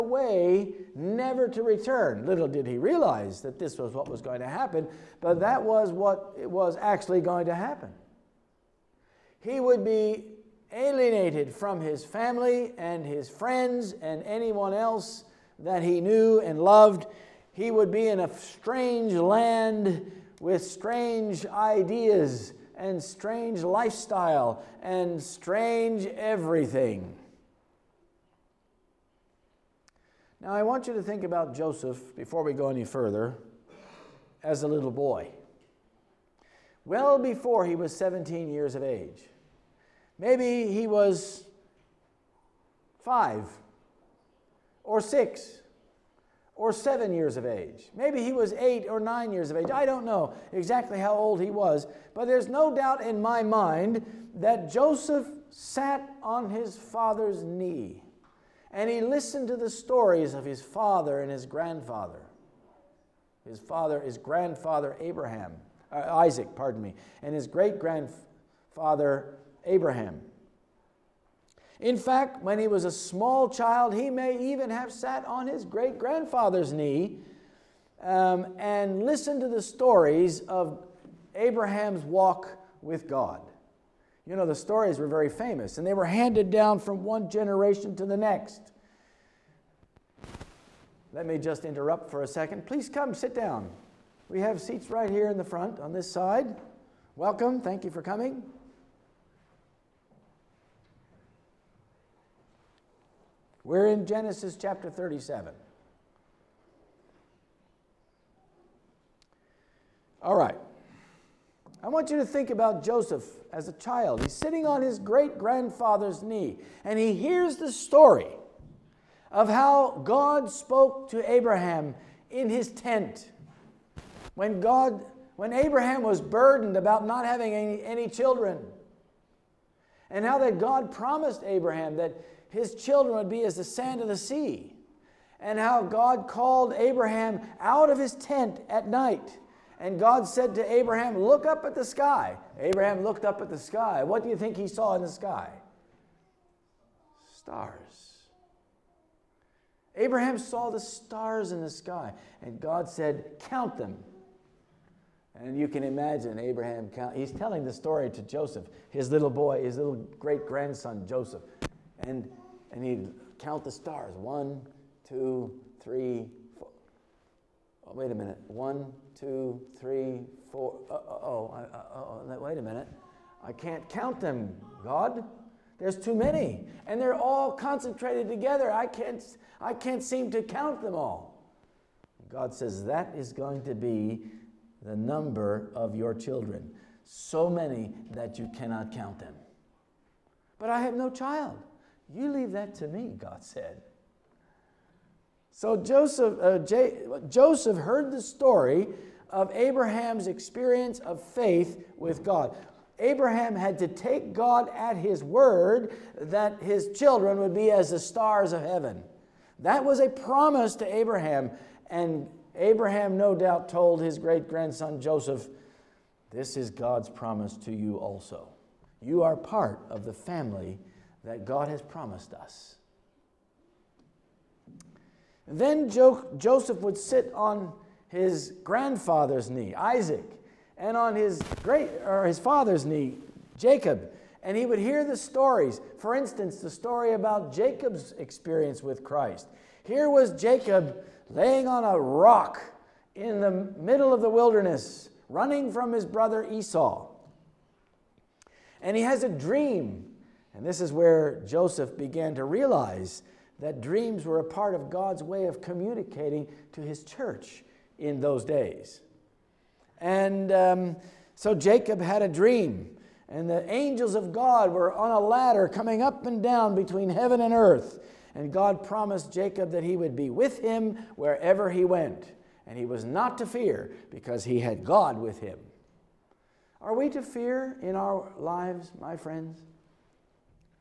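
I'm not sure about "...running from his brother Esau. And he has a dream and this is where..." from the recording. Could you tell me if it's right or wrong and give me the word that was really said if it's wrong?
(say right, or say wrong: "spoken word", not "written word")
right.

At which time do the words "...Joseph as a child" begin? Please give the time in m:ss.
1:52.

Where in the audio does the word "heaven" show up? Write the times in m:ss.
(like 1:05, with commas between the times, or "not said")
3:28, 4:27.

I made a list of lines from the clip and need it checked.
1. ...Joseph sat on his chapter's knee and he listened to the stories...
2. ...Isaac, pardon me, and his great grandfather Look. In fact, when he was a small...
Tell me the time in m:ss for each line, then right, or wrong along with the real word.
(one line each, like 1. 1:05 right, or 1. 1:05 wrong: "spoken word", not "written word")
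1. 0:54 wrong: "father", not "chapter"
2. 1:06 wrong: "Abraham", not "Look".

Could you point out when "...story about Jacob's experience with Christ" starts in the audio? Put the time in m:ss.
3:56.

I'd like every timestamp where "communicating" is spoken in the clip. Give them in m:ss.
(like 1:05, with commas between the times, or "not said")
4:15.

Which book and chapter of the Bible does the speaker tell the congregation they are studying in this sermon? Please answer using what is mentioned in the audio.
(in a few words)
Genesis 37.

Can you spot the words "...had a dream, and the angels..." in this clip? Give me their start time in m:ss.
4:22.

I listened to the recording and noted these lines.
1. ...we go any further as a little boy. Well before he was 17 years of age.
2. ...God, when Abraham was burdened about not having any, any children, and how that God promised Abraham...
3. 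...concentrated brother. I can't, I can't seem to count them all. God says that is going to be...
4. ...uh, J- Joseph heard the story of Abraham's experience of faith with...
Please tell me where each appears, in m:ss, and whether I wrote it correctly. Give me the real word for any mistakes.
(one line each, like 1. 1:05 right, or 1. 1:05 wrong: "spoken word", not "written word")
1. 0:32 right
2. 2:04 right
3. 2:57 wrong: "together", not "brother"
4. 3:16 right.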